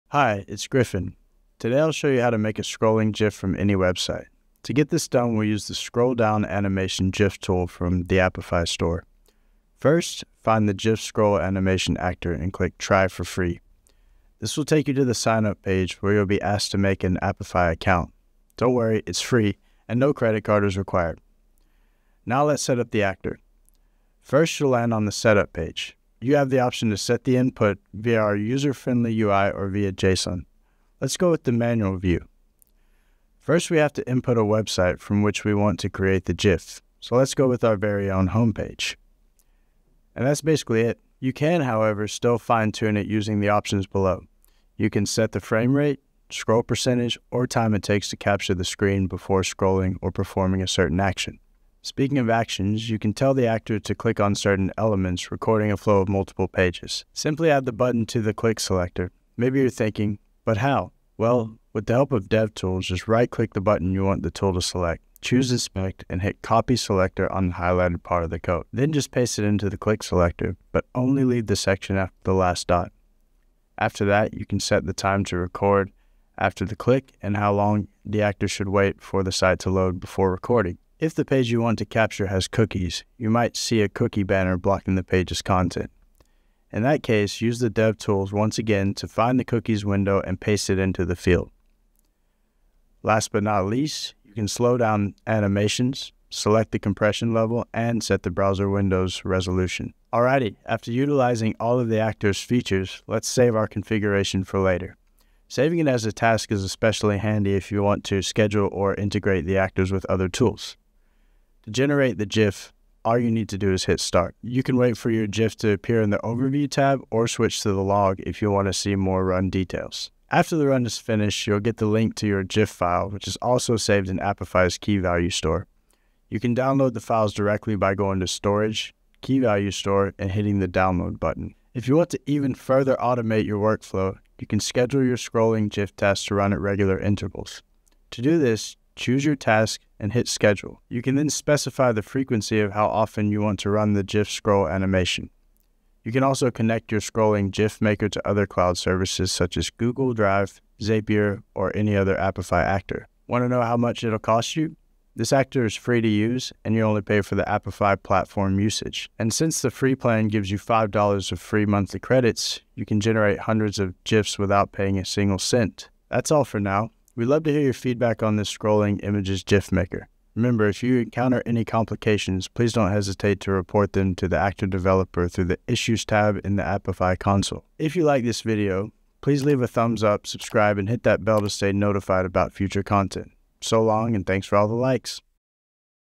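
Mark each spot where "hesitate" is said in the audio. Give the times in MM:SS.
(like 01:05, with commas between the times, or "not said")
02:52.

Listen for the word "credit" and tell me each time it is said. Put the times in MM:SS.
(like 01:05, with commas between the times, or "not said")
00:20, 02:41.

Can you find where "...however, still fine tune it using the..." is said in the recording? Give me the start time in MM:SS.
00:41.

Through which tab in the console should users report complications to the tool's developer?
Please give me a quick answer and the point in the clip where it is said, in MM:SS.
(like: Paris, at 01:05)
Issues tab, at 02:55.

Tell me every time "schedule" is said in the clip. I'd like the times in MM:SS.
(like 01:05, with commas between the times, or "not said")
01:48, 02:14, 02:20.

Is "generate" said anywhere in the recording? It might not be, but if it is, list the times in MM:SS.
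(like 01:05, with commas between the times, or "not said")
01:51, 02:42.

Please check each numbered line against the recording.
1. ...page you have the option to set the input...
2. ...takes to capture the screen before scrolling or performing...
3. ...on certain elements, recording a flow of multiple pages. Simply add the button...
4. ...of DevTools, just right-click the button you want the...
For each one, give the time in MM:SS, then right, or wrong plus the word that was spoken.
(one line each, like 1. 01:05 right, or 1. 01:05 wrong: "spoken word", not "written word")
1. 00:25 right
2. 00:47 right
3. 00:54 right
4. 01:02 right.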